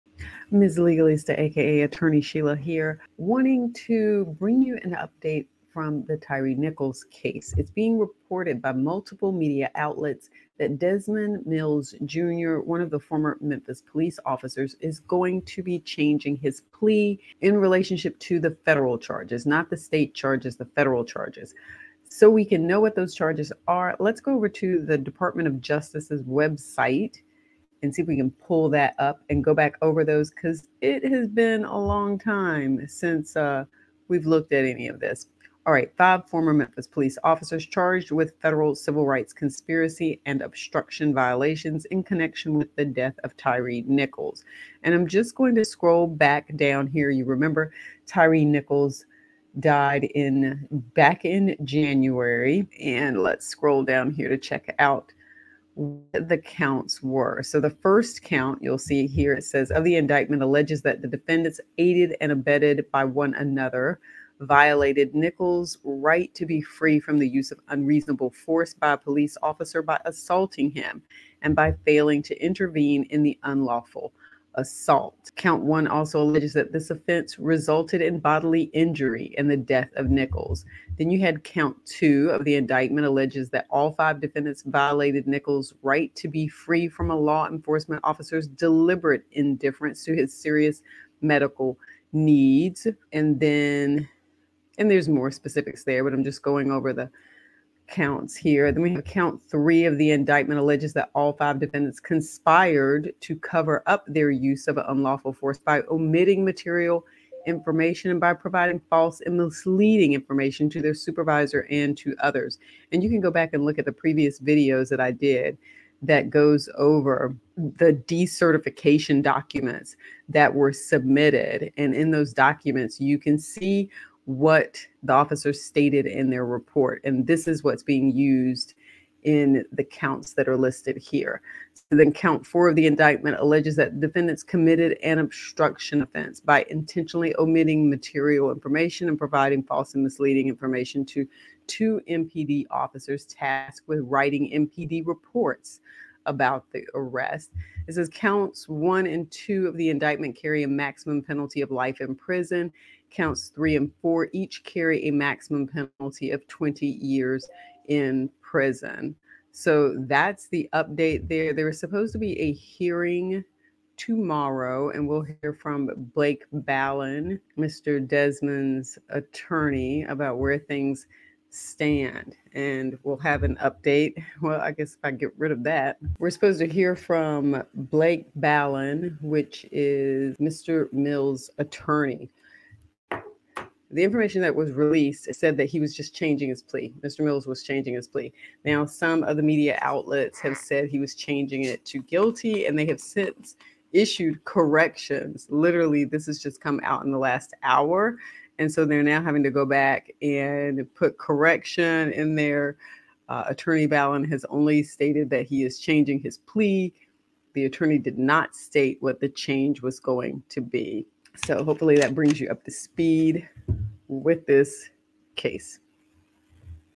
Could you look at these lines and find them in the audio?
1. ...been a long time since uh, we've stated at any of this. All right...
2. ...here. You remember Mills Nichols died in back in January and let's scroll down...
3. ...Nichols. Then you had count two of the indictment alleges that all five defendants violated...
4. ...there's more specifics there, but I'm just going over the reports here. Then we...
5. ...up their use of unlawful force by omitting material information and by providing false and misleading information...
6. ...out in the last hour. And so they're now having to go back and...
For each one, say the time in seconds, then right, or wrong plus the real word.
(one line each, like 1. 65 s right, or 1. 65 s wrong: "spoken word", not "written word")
1. 31 s wrong: "looked", not "stated"
2. 46 s wrong: "Tyre", not "Mills"
3. 80 s right
4. 94 s wrong: "counts", not "reports"
5. 103 s right
6. 196 s right.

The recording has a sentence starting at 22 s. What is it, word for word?
So we can know what those charges are.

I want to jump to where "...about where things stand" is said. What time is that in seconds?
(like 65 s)
170 s.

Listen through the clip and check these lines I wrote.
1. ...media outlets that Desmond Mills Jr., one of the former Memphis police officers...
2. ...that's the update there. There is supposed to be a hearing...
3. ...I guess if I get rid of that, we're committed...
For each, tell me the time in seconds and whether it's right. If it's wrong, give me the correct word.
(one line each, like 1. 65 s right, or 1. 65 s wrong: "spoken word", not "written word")
1. 9 s right
2. 160 s right
3. 174 s wrong: "supposed", not "committed".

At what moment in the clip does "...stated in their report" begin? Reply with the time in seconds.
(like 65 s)
125 s.